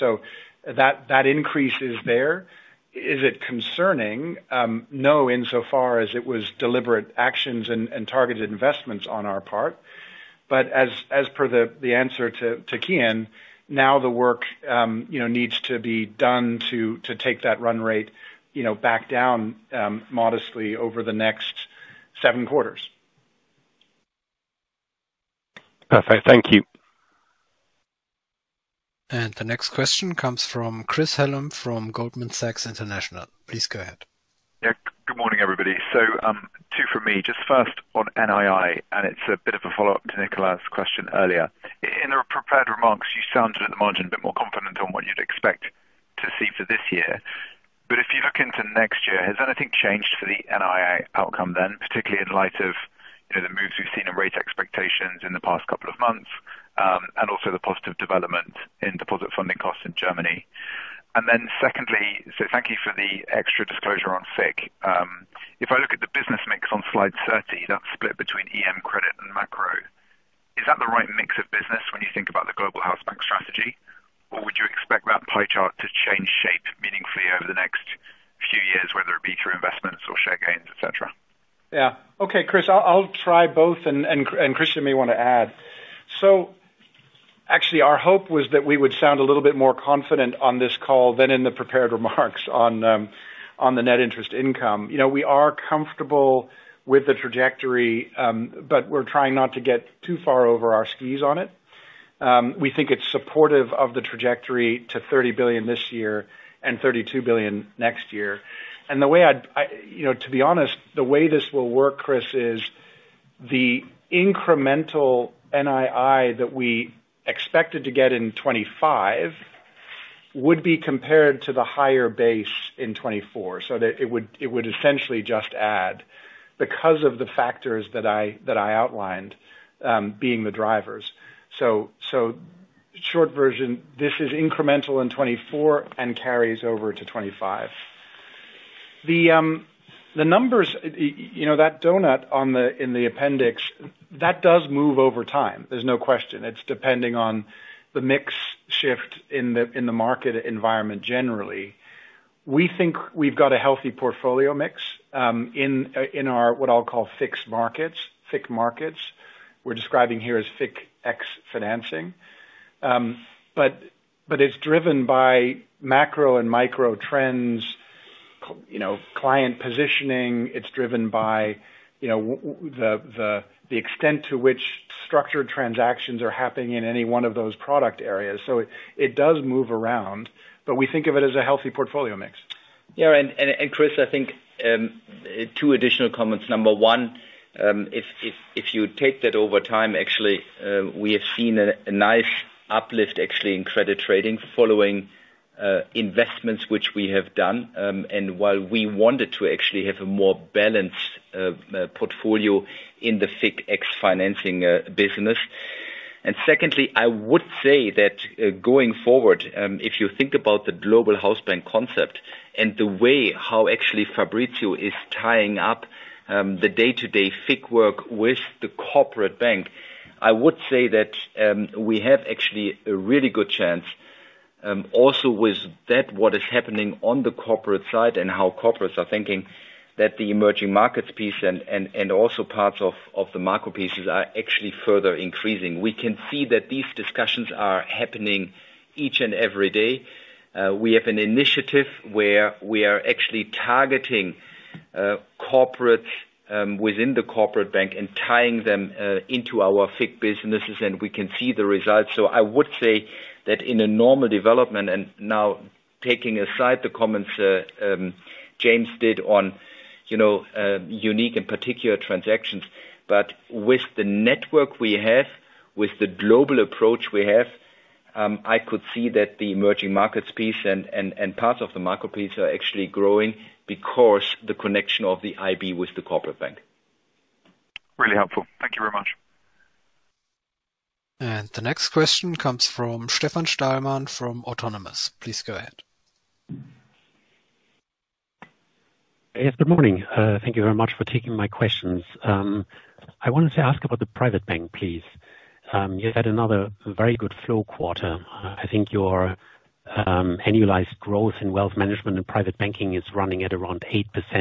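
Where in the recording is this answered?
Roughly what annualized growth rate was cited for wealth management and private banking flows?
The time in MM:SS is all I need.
05:03.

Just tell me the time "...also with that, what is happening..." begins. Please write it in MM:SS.
03:44.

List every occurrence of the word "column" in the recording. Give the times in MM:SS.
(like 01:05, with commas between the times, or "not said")
not said.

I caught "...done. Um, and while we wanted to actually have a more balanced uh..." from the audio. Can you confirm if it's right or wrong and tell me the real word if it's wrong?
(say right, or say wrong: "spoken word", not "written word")
right.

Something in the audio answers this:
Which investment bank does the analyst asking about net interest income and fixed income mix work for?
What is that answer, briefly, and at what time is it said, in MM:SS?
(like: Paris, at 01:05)
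Goldman Sachs International, at 00:31.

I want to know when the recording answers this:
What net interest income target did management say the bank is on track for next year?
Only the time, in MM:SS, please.
01:46.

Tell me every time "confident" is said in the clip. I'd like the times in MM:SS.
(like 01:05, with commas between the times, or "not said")
00:44, 01:29.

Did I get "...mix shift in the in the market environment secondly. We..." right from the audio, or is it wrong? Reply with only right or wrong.
wrong.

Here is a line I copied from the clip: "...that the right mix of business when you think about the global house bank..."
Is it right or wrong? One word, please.
right.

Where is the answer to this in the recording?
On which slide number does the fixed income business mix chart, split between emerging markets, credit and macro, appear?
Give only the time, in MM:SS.
01:06.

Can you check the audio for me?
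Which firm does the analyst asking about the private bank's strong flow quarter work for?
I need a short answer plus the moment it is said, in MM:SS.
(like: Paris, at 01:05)
Autonomous, at 04:44.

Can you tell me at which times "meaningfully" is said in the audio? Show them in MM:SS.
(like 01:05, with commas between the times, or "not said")
01:16.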